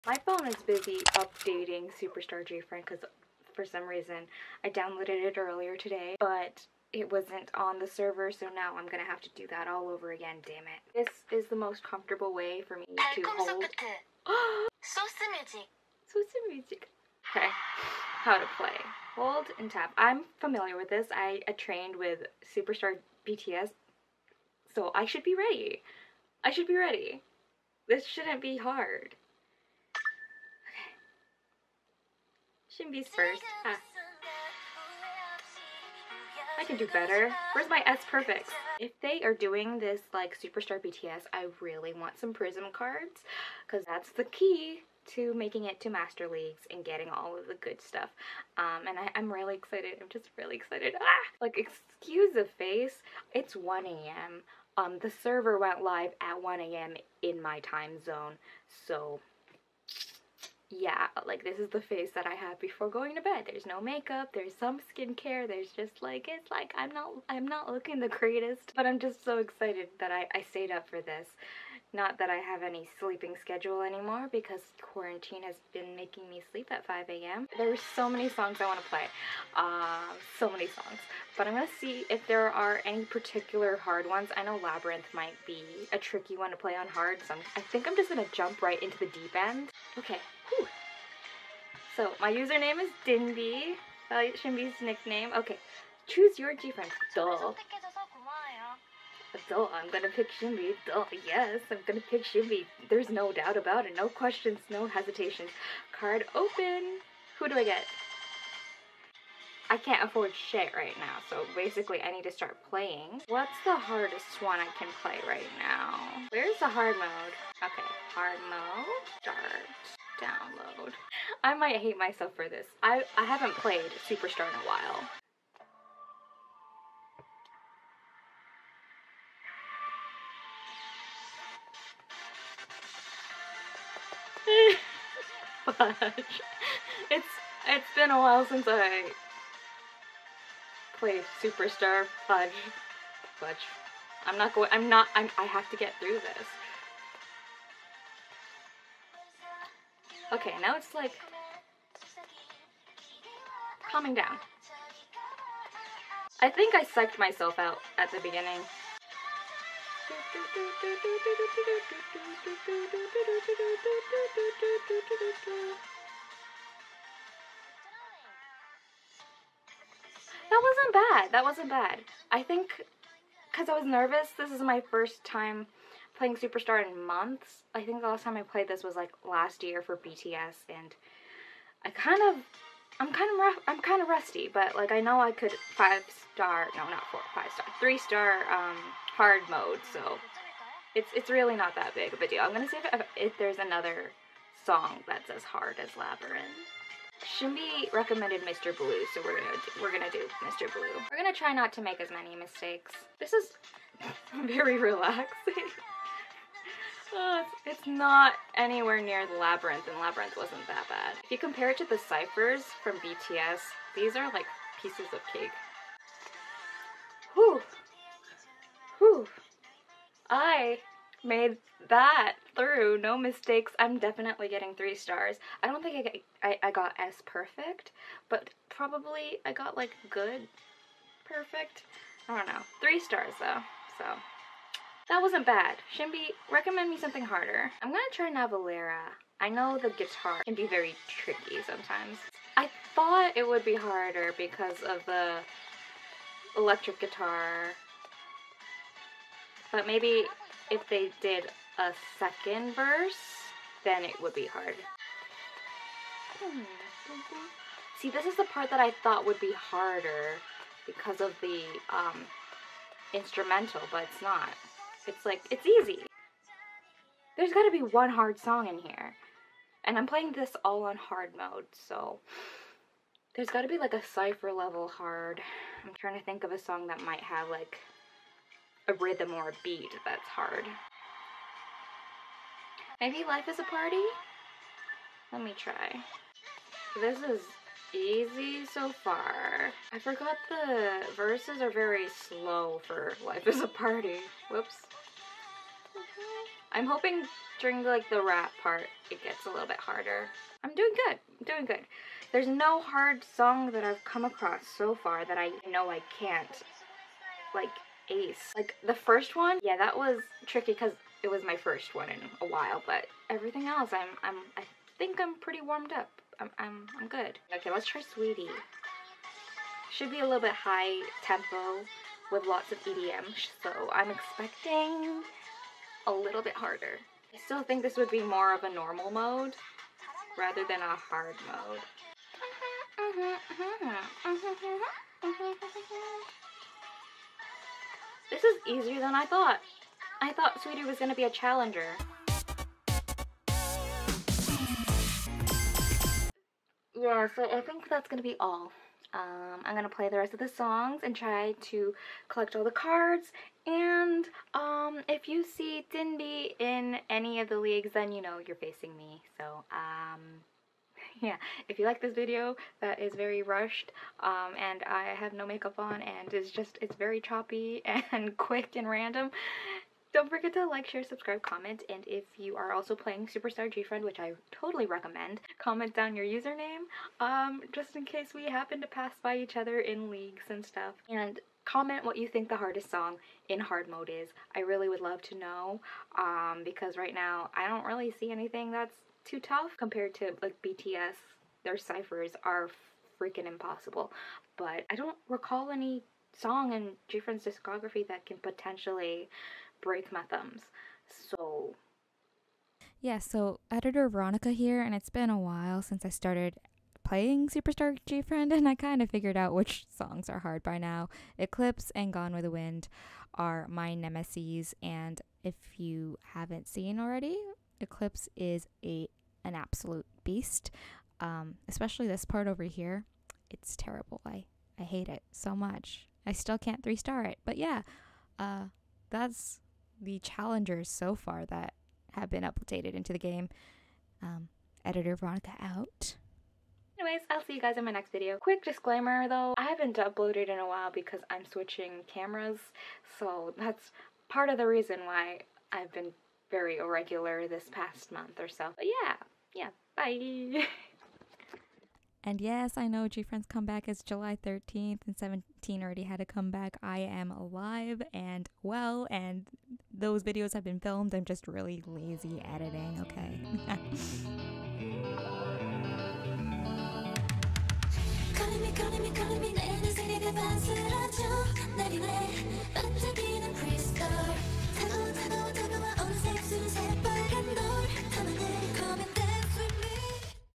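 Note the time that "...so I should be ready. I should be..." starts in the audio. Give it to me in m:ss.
0:24.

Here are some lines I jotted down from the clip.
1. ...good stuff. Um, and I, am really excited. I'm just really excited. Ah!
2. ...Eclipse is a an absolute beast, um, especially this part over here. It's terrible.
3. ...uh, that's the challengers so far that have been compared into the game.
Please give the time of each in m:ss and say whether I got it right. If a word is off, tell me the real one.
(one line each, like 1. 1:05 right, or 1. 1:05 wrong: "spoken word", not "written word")
1. 0:47 right
2. 6:57 right
3. 7:08 wrong: "updated", not "compared".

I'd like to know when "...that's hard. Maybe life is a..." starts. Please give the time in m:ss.
4:40.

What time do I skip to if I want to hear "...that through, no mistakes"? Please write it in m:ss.
3:41.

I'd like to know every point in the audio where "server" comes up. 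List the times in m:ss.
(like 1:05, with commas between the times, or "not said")
0:07, 0:55.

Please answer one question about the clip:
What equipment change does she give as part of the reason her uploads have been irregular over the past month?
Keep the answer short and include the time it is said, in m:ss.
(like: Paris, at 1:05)
switching cameras, at 7:21.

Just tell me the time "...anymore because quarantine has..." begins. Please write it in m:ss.
1:13.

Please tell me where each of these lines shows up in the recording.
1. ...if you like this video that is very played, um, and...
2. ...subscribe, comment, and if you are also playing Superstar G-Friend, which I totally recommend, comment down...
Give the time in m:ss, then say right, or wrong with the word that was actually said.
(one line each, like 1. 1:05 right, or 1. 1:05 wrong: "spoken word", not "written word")
1. 6:01 wrong: "rushed", not "played"
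2. 6:11 right.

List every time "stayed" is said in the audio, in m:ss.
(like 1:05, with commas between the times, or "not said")
1:10.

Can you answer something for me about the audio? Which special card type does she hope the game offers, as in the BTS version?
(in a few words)
Prism cards.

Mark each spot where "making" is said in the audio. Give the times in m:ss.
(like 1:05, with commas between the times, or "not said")
0:45, 1:15.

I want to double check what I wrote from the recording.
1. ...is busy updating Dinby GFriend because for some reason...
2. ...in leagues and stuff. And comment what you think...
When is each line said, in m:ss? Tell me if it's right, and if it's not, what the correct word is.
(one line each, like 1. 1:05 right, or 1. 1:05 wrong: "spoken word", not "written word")
1. 0:00 wrong: "Superstar", not "Dinby"
2. 6:19 right.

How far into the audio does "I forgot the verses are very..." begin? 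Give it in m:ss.
4:49.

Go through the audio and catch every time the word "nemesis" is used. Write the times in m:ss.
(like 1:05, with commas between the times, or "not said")
6:53.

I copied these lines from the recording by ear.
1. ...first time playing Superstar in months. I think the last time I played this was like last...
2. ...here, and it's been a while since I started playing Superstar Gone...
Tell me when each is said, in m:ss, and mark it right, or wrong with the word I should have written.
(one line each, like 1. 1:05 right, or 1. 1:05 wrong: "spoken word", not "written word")
1. 2:54 right
2. 6:44 wrong: "GFriend", not "Gone".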